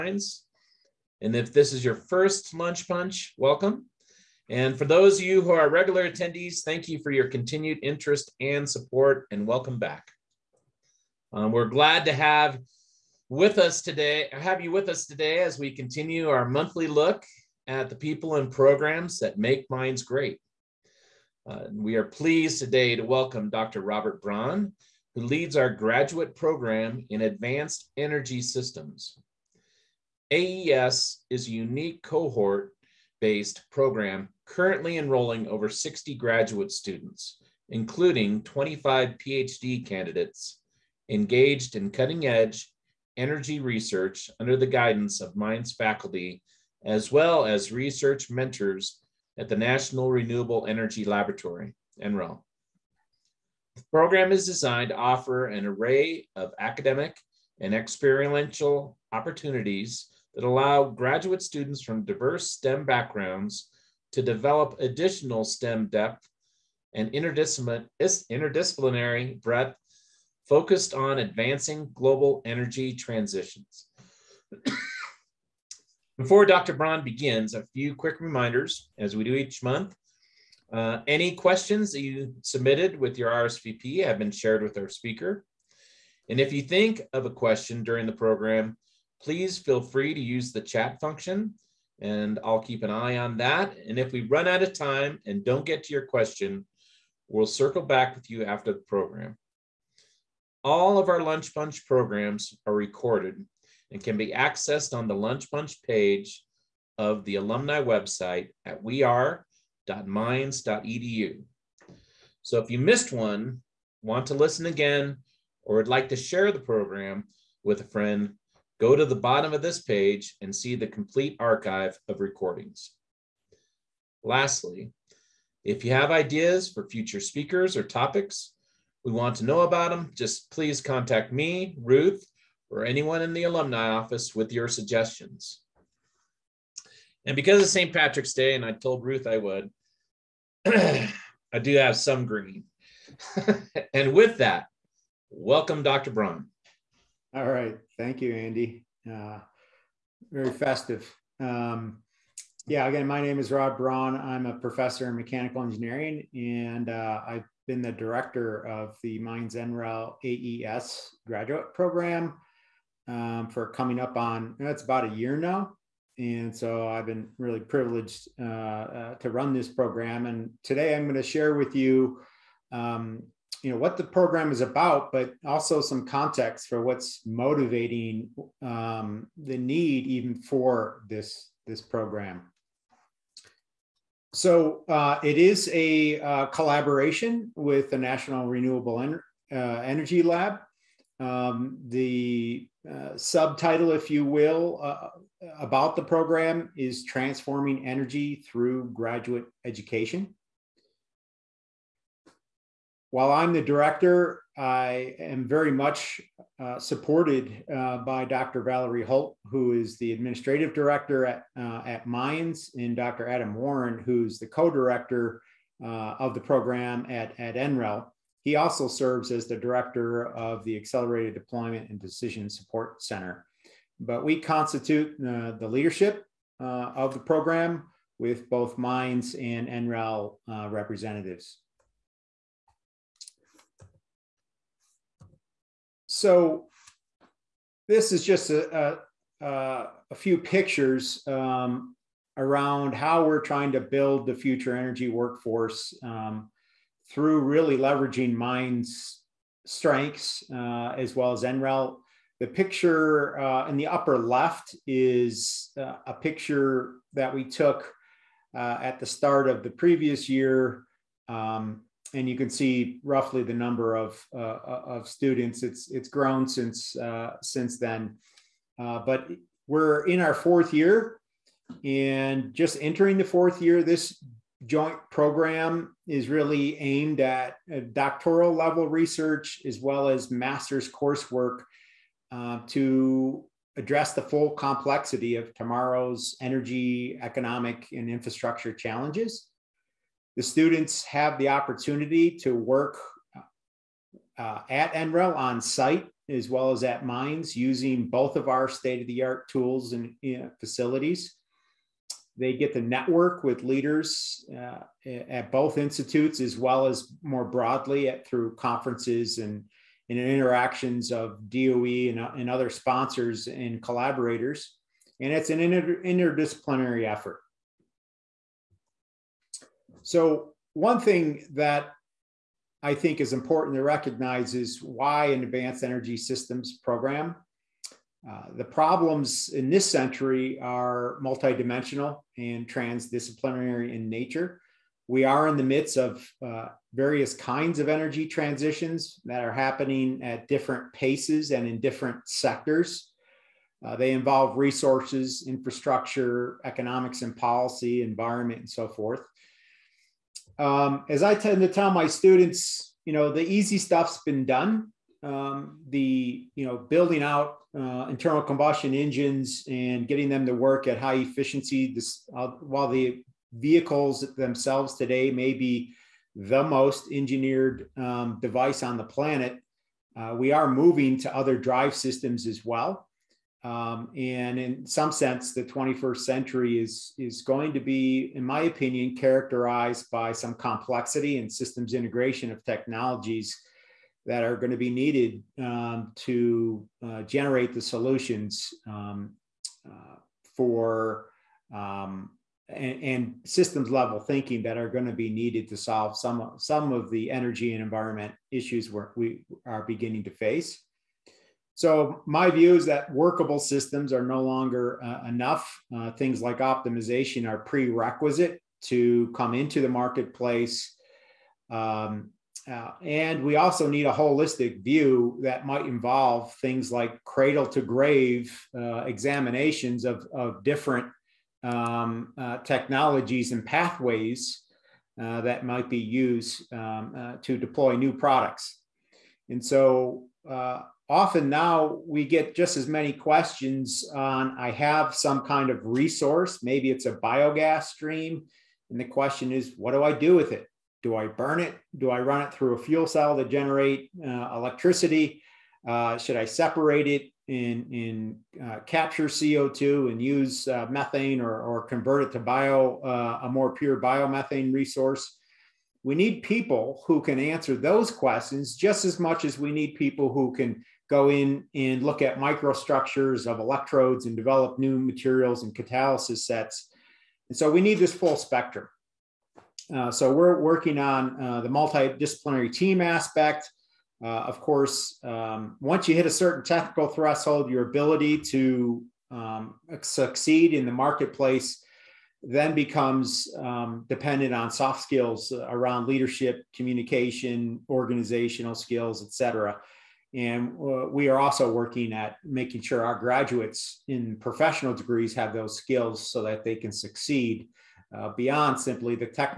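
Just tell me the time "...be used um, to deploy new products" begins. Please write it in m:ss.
7:05.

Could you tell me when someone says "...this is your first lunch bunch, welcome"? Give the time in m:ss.
0:01.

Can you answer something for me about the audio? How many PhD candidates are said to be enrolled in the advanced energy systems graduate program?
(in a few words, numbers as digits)
25.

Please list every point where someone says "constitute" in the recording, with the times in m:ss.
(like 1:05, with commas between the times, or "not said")
3:44.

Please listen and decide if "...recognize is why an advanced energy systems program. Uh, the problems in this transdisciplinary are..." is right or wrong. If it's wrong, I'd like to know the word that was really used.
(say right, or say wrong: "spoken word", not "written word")
wrong: "century", not "transdisciplinary".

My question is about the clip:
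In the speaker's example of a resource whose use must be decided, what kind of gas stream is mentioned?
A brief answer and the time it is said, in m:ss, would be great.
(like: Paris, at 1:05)
Biogas, at 7:17.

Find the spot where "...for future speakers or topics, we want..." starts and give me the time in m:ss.
2:06.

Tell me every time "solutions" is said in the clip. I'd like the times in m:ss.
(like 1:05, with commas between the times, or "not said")
6:27.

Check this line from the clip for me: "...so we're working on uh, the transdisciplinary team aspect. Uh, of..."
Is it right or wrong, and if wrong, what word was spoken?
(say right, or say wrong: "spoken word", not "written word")
wrong: "multidisciplinary", not "transdisciplinary".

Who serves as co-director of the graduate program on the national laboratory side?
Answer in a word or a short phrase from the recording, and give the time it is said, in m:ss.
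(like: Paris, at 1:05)
Adam Warren, at 3:33.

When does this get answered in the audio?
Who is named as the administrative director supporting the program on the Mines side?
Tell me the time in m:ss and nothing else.
3:28.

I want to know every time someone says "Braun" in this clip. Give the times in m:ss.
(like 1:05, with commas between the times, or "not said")
0:24, 1:16, 2:26, 2:33.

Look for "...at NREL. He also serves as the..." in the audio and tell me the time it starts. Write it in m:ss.
3:37.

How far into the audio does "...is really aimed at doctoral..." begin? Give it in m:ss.
4:36.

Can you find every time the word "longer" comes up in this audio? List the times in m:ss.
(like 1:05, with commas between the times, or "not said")
6:44.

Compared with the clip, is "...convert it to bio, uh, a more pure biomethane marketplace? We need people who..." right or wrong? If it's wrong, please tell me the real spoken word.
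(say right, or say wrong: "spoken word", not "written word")
wrong: "resource", not "marketplace".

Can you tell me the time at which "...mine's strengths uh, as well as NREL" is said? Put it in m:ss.
4:08.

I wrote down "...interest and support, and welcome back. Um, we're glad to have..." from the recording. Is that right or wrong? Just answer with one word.
right.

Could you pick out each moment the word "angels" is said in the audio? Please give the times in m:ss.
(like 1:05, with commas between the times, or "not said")
not said.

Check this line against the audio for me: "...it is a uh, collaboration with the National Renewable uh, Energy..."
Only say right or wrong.
right.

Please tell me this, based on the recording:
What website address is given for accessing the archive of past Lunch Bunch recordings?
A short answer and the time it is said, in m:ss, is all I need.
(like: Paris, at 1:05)
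weare.mines.edu, at 1:48.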